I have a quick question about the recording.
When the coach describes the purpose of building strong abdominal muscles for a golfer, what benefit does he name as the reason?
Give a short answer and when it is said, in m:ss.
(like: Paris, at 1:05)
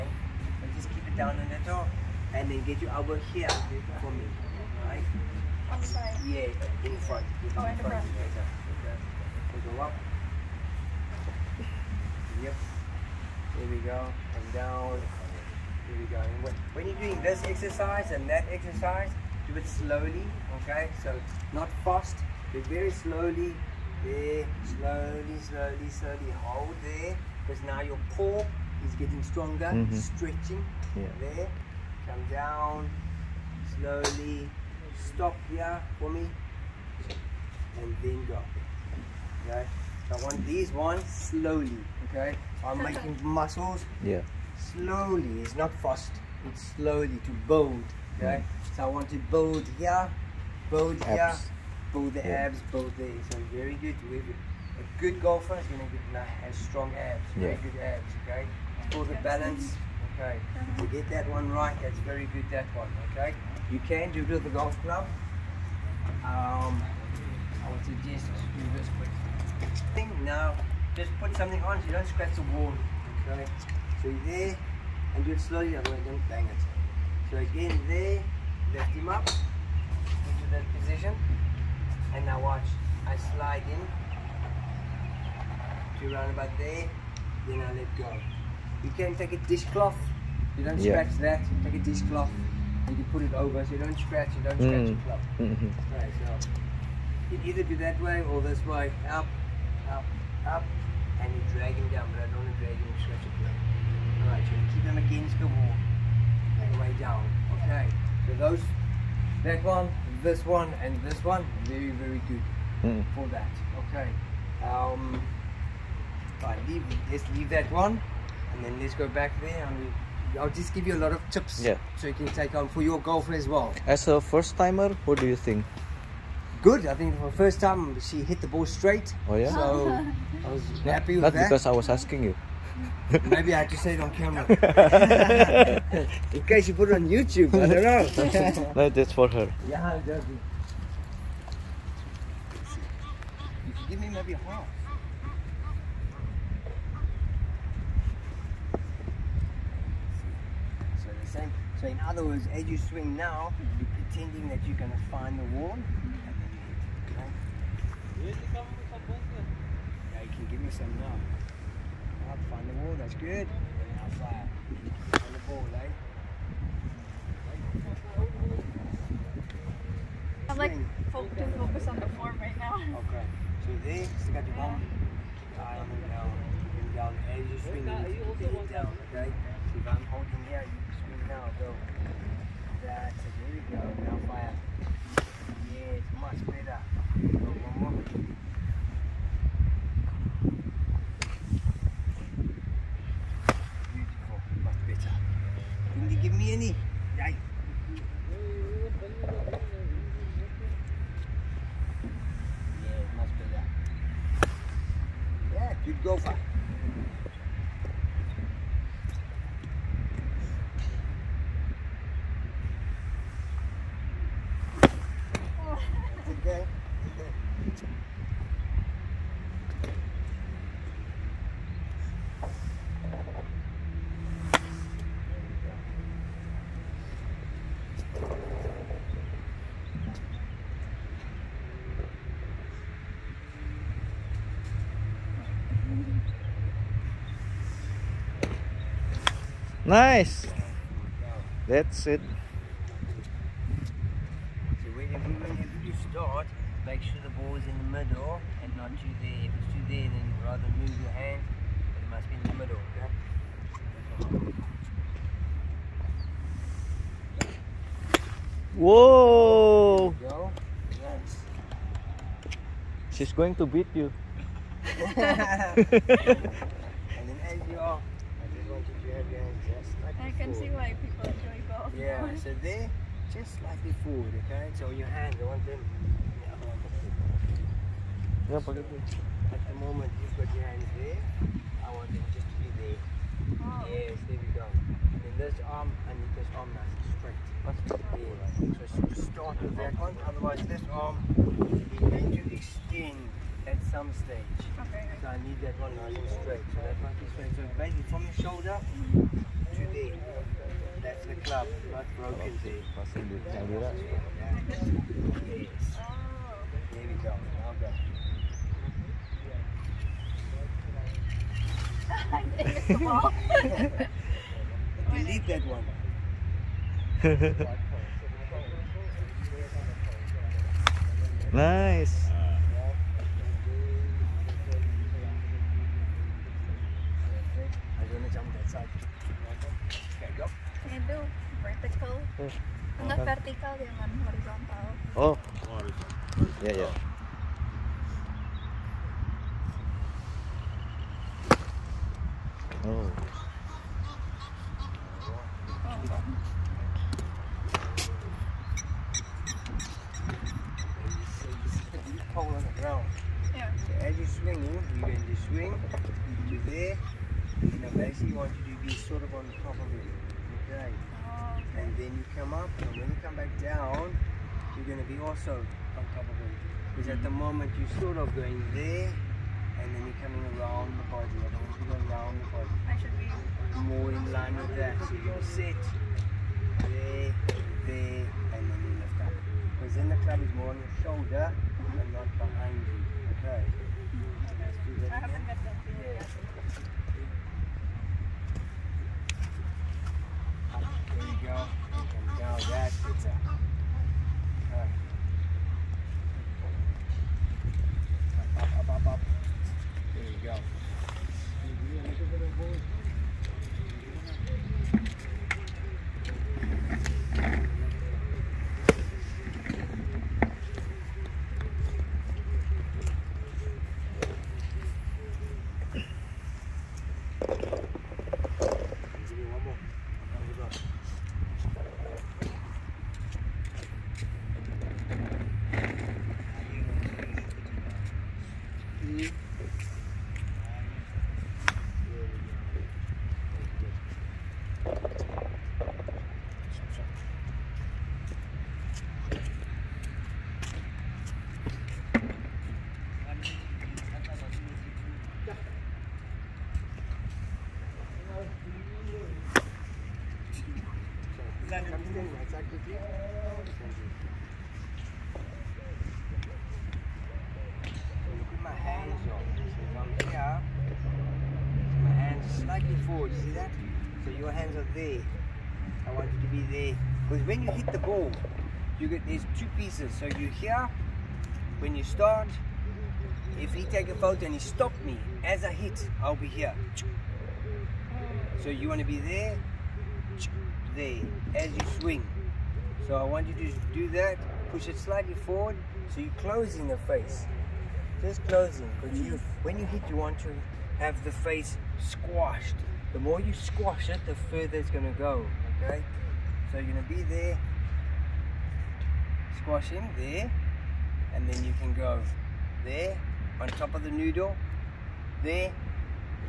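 Balance, at 0:58.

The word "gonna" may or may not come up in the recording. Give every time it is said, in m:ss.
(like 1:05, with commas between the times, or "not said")
0:55.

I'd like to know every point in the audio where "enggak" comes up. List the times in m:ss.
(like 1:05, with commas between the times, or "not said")
5:33.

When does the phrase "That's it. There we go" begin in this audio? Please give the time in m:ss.
3:02.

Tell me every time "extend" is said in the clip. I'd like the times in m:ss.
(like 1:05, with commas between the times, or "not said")
4:52.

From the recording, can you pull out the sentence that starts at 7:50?
So you here, when you start, if he take a photo and he stop me, as I hit, I'll be here.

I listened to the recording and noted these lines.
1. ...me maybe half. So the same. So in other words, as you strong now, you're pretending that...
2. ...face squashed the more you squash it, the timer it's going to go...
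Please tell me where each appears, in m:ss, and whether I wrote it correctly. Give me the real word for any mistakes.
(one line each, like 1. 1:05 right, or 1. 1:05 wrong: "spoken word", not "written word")
1. 2:23 wrong: "swing", not "strong"
2. 8:11 wrong: "further", not "timer".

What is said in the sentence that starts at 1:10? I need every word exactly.
Just put something on so you don't scratch the wall.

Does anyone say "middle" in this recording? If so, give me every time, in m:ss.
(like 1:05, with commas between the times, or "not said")
4:07, 4:12.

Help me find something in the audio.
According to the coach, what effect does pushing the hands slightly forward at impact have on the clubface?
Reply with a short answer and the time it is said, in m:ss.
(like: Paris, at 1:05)
Closing the face, at 8:06.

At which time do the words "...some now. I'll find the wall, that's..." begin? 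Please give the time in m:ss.
2:40.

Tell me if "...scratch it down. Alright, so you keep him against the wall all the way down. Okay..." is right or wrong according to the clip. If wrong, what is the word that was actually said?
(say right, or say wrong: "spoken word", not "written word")
wrong: "stretch", not "scratch".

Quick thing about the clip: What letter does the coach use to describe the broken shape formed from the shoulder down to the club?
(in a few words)
Z.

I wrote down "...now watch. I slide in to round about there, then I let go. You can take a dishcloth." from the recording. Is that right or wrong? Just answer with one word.
right.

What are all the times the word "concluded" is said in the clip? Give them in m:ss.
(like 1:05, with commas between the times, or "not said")
not said.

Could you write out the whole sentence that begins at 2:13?
Maybe I had to say it on camera.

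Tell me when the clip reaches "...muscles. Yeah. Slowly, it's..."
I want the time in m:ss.
0:43.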